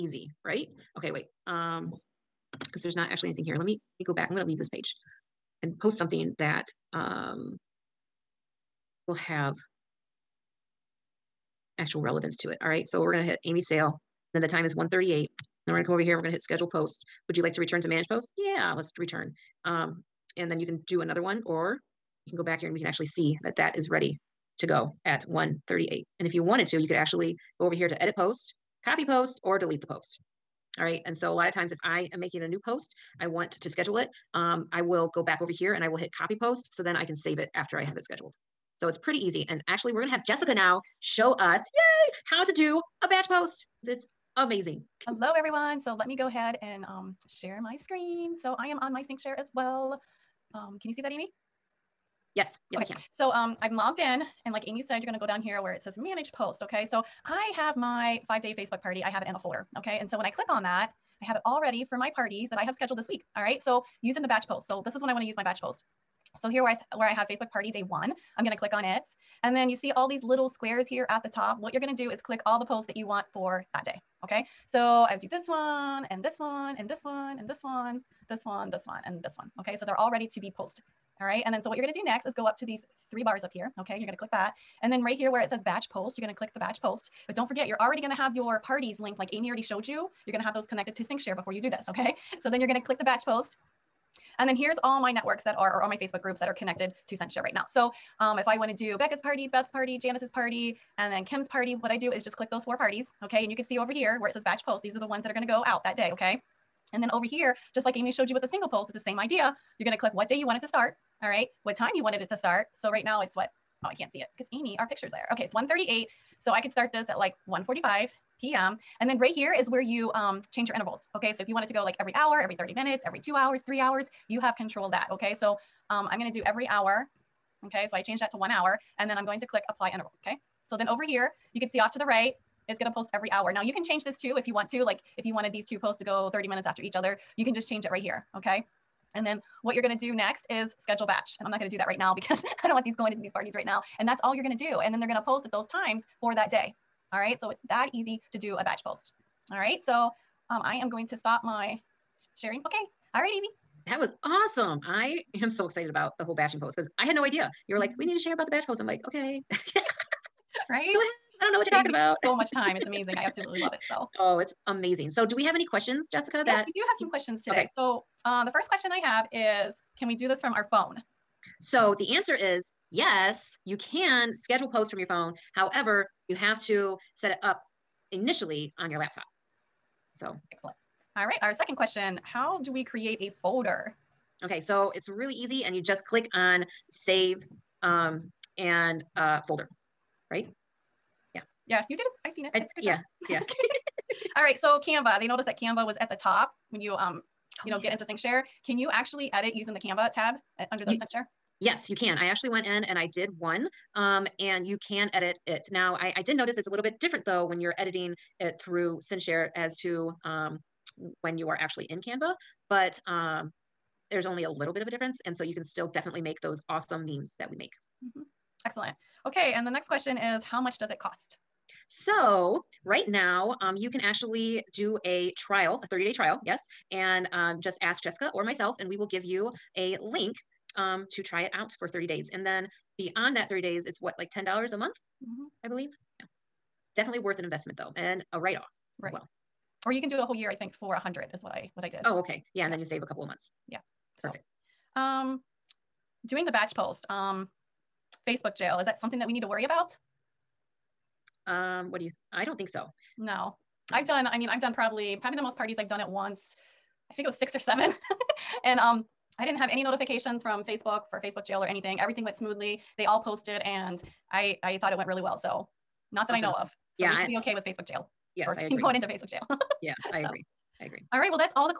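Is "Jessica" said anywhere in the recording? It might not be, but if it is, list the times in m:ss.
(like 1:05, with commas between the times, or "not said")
0:40, 2:46, 3:48.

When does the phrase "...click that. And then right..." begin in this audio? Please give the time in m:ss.
1:24.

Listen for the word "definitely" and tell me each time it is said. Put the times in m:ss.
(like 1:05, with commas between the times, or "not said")
3:35, 3:56.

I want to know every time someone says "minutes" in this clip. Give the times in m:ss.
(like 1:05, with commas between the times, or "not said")
2:02, 2:16.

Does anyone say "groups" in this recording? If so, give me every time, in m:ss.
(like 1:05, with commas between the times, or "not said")
1:36.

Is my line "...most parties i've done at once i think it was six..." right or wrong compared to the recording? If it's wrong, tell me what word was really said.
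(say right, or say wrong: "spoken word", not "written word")
right.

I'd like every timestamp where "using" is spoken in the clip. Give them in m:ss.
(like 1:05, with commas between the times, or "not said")
1:04, 3:19.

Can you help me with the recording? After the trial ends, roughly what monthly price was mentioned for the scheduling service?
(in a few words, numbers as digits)
$10 a month.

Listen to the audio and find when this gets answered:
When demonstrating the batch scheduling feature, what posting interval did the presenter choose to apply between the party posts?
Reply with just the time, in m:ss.
2:08.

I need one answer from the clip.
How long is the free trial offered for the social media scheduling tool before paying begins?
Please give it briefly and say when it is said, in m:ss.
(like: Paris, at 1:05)
30 days, at 3:45.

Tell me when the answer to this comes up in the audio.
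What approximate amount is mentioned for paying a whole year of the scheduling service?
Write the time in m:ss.
4:00.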